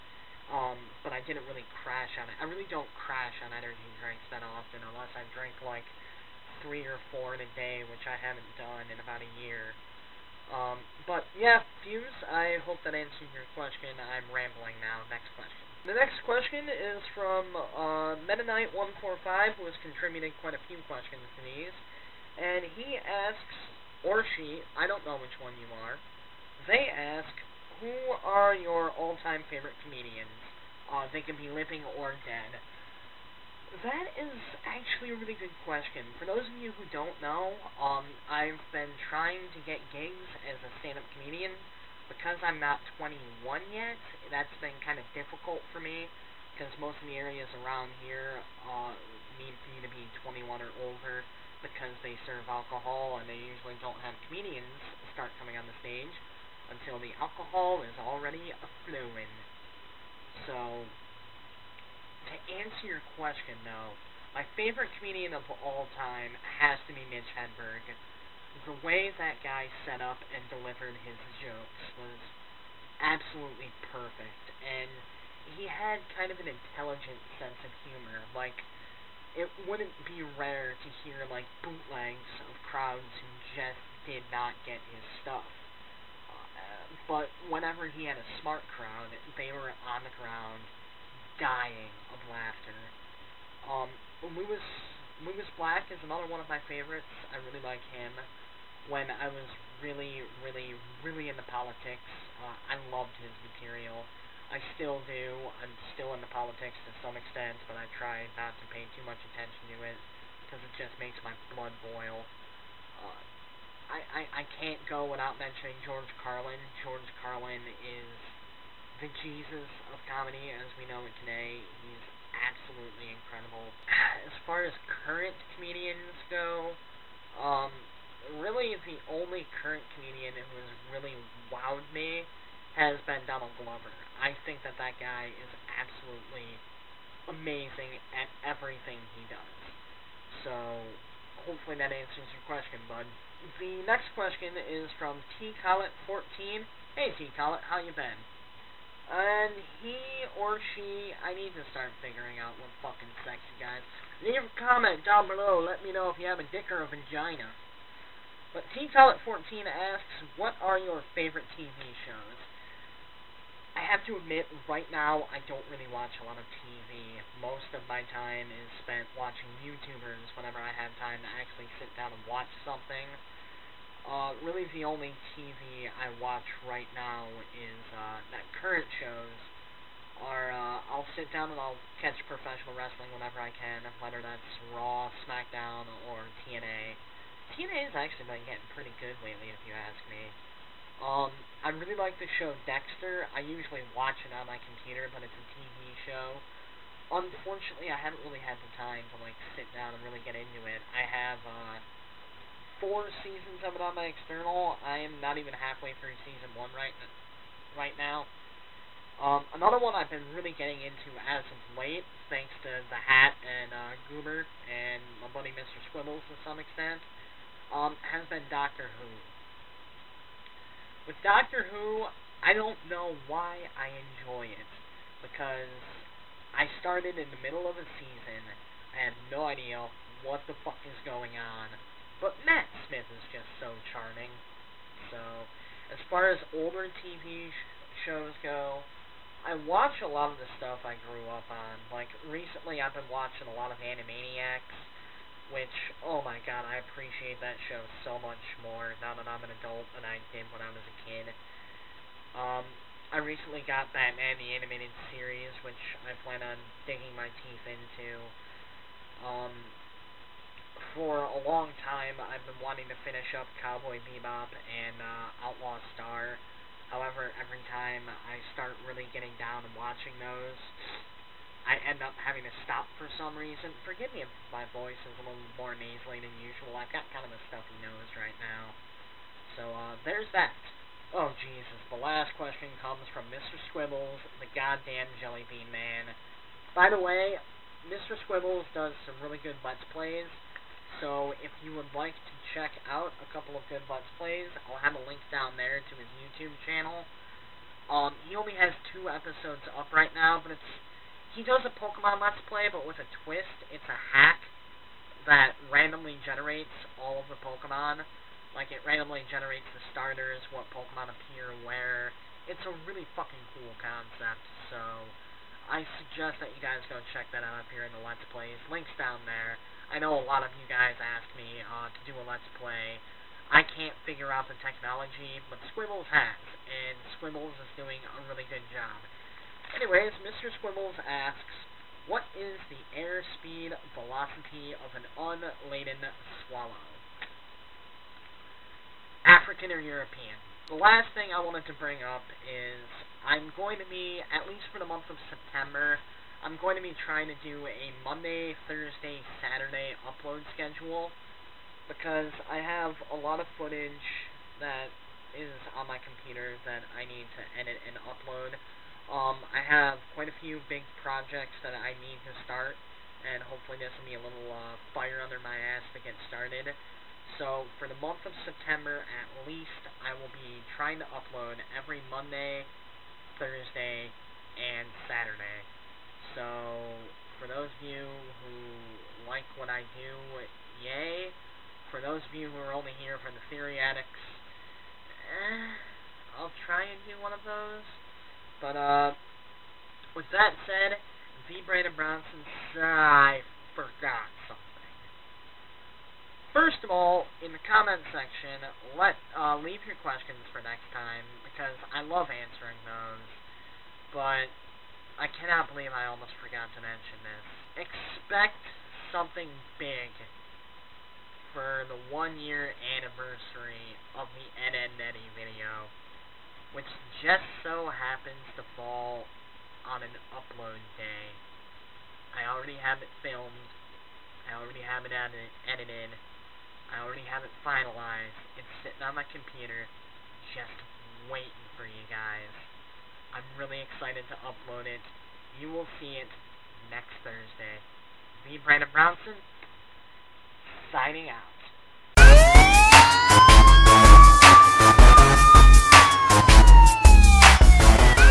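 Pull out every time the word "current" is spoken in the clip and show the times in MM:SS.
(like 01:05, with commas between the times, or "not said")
02:05, 02:09, 02:58.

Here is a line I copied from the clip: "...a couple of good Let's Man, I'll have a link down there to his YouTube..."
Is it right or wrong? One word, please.
wrong.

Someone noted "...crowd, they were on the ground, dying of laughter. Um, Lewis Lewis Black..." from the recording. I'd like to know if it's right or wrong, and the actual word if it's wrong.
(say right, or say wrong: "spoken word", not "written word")
right.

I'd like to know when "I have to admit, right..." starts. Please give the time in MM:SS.
02:43.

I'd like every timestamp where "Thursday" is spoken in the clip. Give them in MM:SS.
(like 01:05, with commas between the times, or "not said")
05:48, 06:13, 07:17.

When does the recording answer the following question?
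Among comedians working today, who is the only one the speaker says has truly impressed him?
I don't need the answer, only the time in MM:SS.
02:13.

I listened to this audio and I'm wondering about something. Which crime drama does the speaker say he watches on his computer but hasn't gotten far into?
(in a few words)
Dexter.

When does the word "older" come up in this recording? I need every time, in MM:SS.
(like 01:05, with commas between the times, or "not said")
00:50, 03:56.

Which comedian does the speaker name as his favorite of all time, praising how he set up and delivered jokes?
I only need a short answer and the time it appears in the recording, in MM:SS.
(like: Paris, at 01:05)
Mitch Hedberg, at 01:07.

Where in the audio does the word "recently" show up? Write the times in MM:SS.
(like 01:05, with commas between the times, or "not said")
04:02, 04:13.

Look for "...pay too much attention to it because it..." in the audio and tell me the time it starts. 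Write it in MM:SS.
01:48.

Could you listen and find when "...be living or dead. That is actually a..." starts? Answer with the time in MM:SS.
00:31.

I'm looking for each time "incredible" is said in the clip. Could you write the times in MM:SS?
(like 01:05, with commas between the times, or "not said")
02:03.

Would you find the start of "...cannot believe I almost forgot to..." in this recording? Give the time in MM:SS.
06:45.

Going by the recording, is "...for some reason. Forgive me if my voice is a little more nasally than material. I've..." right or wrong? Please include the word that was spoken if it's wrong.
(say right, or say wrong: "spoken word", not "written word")
wrong: "usual", not "material".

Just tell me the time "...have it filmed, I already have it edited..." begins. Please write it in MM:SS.
07:02.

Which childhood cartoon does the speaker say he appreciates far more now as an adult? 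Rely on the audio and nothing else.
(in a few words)
Animaniacs.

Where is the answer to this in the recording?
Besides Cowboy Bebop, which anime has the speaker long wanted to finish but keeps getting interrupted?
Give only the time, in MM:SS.
04:25.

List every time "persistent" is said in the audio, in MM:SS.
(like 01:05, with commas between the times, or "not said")
not said.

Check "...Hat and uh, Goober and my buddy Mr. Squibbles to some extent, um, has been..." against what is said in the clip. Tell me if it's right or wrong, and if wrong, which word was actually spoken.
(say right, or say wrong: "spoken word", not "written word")
right.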